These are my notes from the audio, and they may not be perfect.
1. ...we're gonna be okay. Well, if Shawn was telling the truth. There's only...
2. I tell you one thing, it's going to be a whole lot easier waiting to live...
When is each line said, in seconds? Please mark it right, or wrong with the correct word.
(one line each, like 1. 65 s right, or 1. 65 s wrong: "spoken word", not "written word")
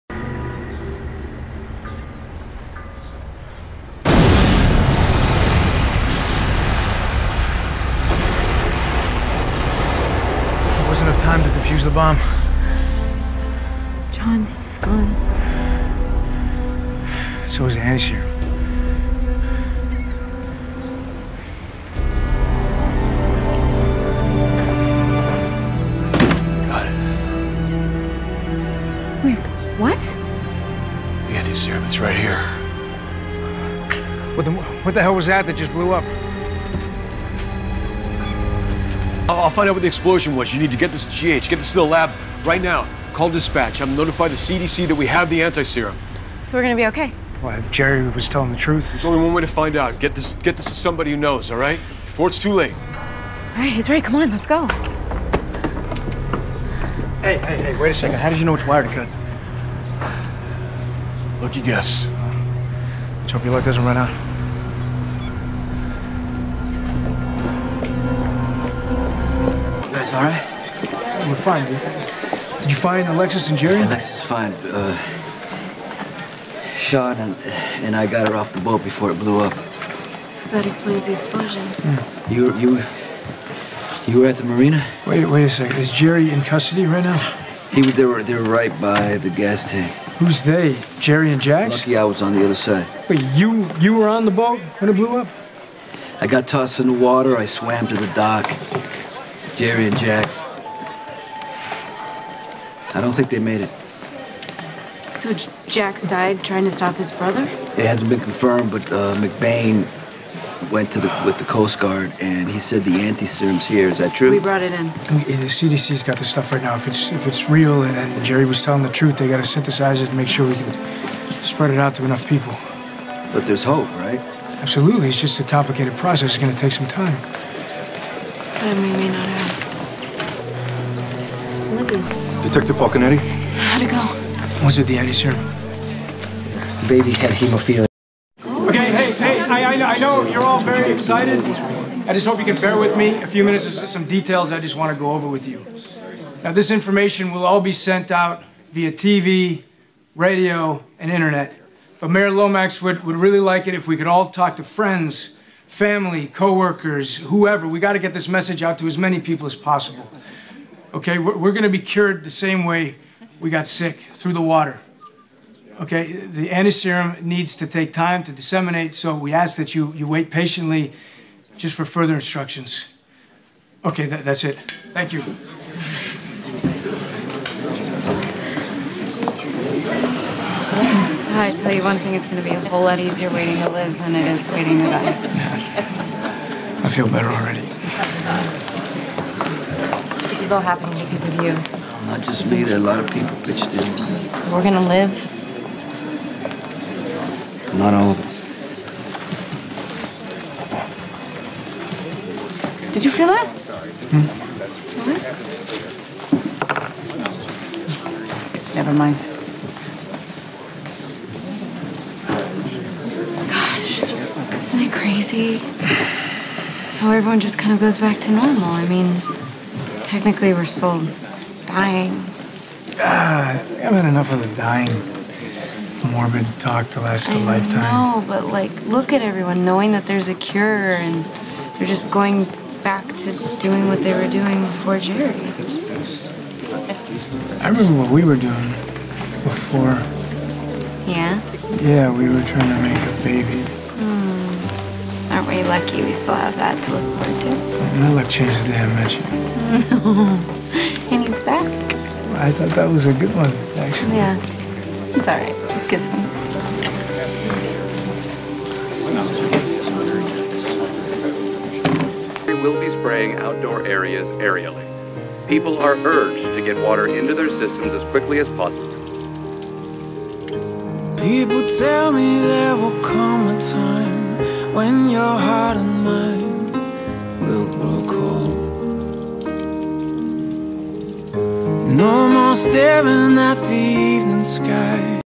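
1. 46 s wrong: "Jerry", not "Shawn"
2. 181 s right.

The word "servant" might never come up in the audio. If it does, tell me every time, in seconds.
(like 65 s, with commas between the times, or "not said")
not said.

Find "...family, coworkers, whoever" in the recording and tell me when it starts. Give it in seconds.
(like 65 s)
155 s.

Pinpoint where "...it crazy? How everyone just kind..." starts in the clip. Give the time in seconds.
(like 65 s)
214 s.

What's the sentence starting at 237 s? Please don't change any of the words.
I remember what we were doing before.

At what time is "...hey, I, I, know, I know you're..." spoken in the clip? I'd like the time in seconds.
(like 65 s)
139 s.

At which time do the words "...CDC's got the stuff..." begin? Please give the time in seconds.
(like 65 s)
115 s.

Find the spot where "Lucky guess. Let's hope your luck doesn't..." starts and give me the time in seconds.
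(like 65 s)
61 s.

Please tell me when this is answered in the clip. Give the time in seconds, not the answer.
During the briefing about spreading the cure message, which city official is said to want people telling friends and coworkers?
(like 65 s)
152 s.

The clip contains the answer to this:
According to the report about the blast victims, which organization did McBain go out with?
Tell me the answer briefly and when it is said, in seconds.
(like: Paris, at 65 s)
Coast Guard, at 111 s.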